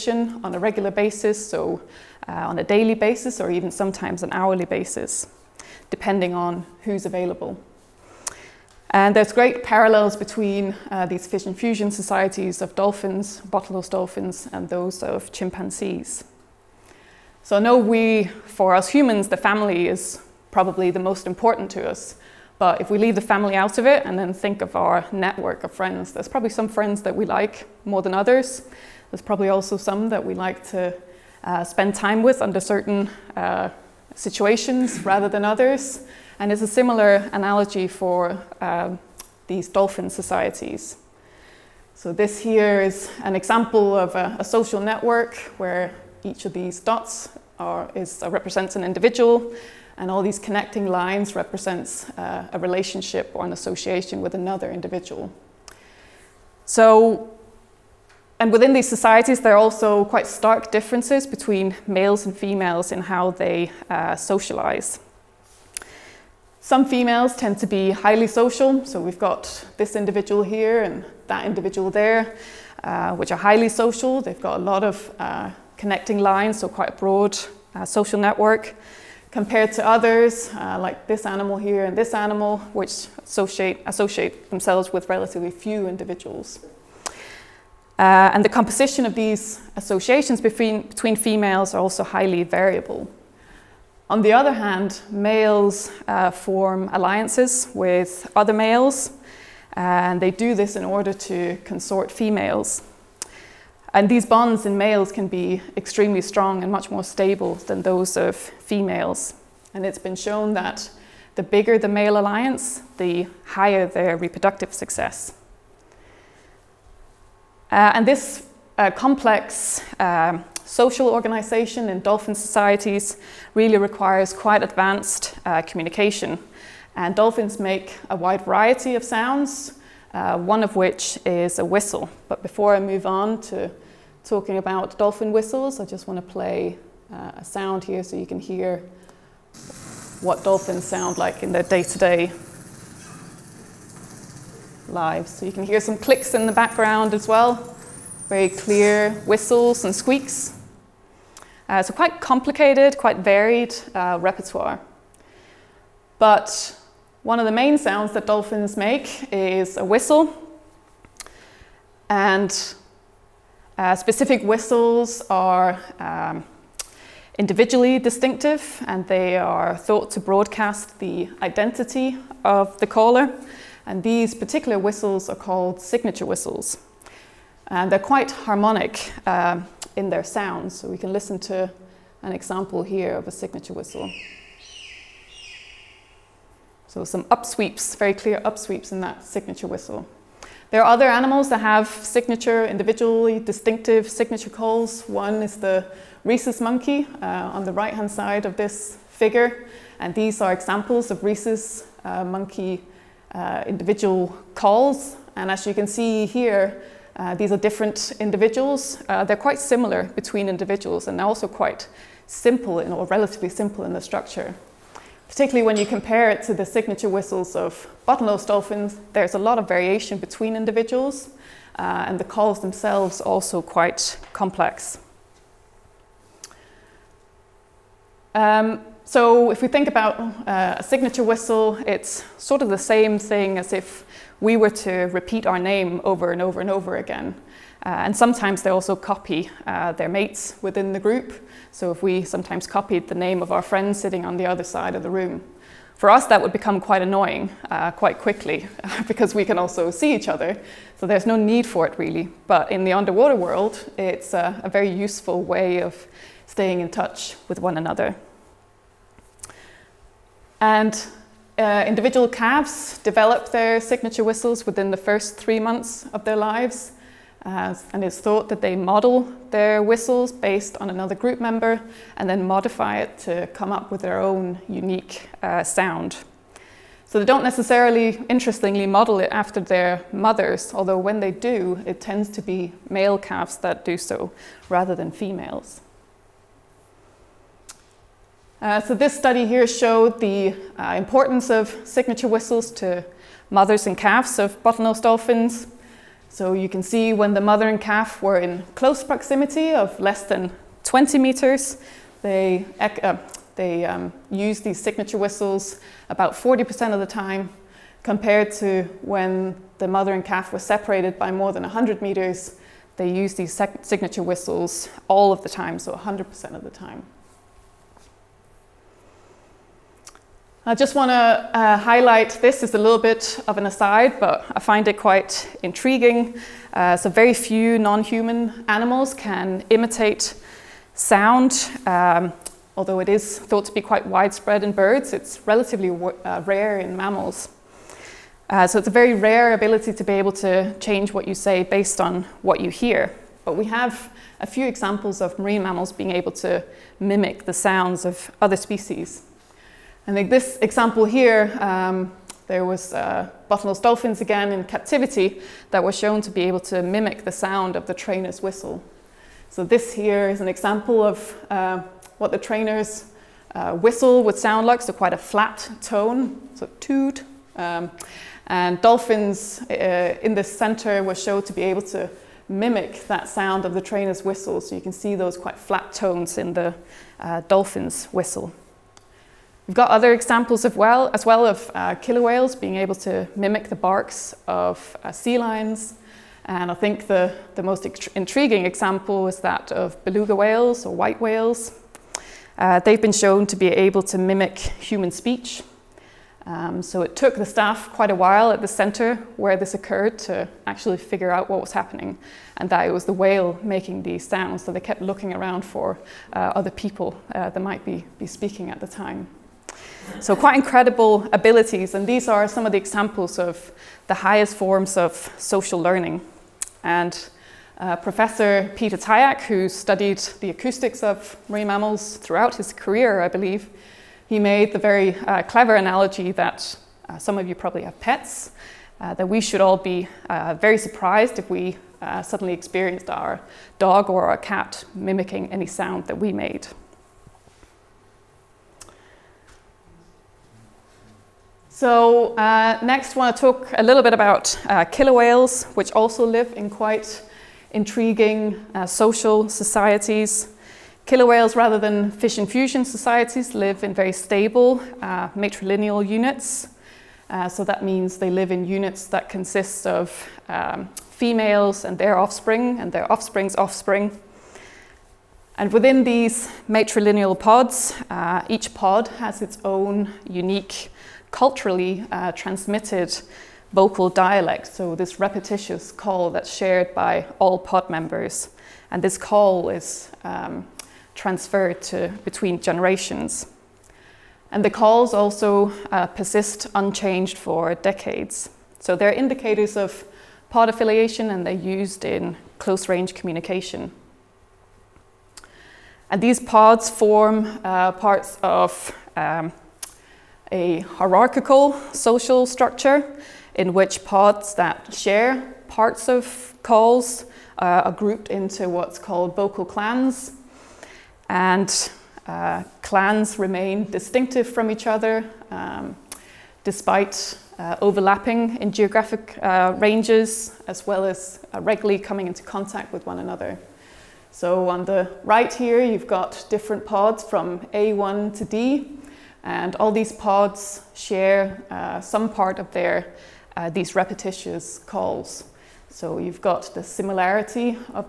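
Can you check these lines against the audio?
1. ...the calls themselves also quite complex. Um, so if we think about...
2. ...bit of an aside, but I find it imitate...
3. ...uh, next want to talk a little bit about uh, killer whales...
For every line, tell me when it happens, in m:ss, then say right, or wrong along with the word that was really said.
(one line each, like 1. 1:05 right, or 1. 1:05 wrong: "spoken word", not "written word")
1. 3:42 right
2. 5:22 wrong: "quite", not "imitate"
3. 7:22 right.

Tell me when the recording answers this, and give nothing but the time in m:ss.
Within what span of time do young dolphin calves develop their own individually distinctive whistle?
4:24.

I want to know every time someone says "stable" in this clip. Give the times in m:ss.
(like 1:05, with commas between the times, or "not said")
1:47, 7:34.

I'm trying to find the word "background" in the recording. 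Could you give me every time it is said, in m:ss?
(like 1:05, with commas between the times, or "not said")
2:26.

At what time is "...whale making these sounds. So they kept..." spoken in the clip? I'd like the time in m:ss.
6:43.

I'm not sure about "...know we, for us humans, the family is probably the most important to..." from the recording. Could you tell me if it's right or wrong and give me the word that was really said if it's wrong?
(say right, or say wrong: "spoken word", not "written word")
right.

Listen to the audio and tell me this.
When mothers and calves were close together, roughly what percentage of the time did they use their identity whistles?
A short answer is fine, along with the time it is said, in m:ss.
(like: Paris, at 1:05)
40%, at 5:06.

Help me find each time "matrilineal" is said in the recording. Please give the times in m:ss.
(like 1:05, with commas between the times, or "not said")
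7:35, 7:46.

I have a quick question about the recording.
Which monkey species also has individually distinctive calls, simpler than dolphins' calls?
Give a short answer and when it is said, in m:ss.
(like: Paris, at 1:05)
rhesus monkey, at 3:16.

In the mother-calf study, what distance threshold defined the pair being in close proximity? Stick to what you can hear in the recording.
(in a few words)
20 meters.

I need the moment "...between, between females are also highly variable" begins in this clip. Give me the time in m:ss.
1:30.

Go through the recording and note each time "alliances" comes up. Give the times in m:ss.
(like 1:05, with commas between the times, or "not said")
1:36, 1:52.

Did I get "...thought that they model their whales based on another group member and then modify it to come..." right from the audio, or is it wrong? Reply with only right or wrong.
wrong.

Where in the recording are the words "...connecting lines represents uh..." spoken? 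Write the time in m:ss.
0:50.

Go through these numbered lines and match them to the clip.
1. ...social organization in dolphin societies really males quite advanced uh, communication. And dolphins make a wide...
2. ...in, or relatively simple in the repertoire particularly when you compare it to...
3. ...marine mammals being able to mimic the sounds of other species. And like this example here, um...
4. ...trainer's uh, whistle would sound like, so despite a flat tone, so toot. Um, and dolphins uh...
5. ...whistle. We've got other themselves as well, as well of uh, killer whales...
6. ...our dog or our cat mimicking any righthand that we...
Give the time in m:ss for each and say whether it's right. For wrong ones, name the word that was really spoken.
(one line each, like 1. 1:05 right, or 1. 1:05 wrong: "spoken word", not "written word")
1. 2:00 wrong: "requires", not "males"
2. 3:32 wrong: "structure", not "repertoire"
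3. 5:45 right
4. 6:02 wrong: "quite", not "despite"
5. 6:18 wrong: "examples", not "themselves"
6. 7:13 wrong: "sound", not "righthand".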